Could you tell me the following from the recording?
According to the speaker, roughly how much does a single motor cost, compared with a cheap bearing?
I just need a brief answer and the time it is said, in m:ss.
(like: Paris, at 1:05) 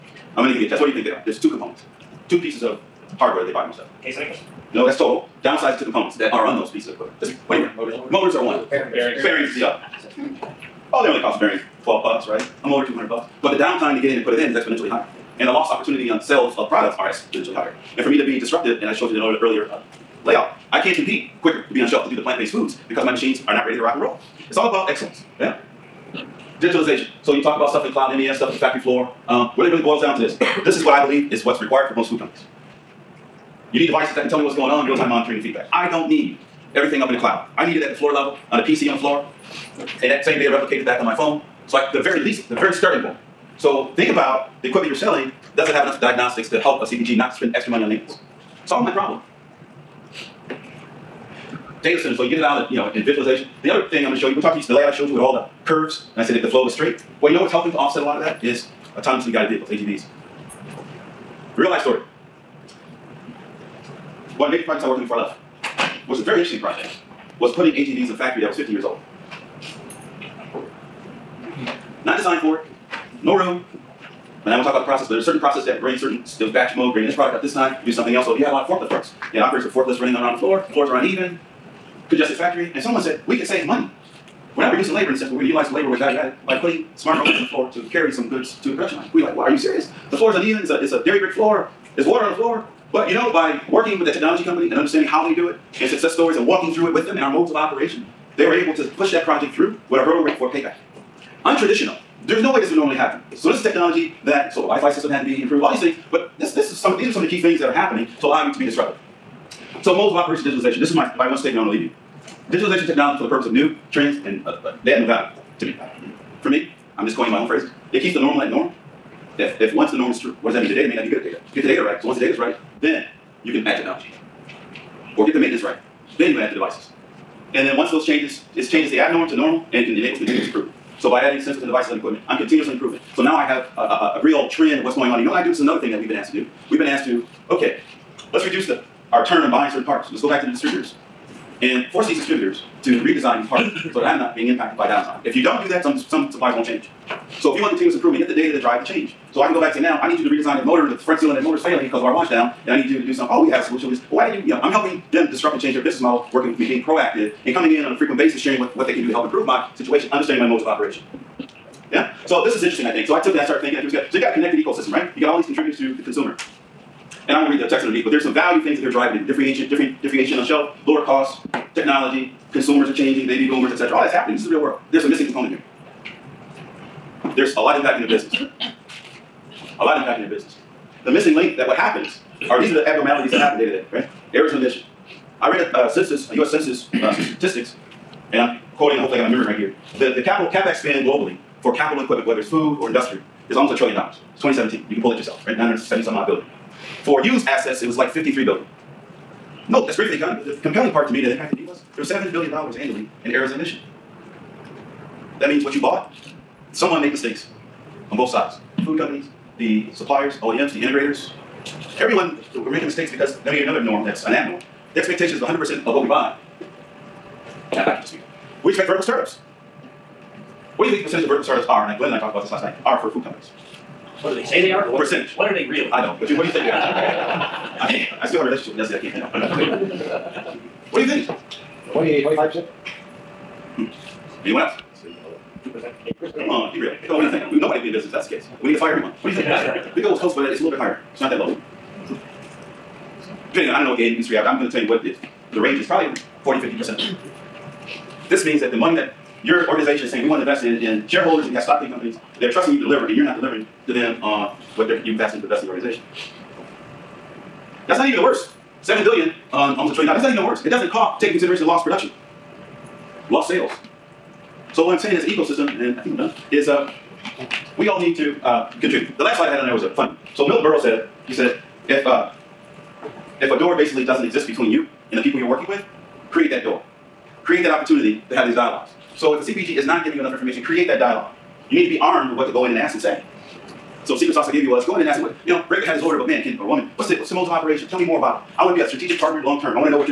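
$200, at 0:12.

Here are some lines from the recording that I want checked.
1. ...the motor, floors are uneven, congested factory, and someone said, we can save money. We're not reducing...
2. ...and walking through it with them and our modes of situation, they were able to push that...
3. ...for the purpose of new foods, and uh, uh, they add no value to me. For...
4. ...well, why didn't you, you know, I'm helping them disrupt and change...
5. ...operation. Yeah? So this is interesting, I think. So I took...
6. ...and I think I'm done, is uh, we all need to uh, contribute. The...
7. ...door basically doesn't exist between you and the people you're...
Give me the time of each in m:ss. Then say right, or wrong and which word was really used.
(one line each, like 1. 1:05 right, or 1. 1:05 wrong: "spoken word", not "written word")
1. 1:20 wrong: "floor", not "motor"
2. 1:36 wrong: "operation", not "situation"
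3. 1:53 wrong: "trends", not "foods"
4. 2:34 right
5. 2:40 right
6. 4:25 right
7. 4:33 right.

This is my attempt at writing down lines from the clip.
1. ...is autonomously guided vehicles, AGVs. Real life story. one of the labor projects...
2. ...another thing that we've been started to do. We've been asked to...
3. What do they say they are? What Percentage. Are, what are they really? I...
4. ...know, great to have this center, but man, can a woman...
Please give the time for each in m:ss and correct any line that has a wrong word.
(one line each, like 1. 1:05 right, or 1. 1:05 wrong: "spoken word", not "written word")
1. 0:58 wrong: "major", not "labor"
2. 2:15 wrong: "asked", not "started"
3. 3:44 right
4. 4:45 wrong: "order", not "center".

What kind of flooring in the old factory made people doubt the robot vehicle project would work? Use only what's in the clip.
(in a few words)
Dairy brick floor.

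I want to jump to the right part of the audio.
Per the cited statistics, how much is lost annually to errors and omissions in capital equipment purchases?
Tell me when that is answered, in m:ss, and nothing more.
3:22.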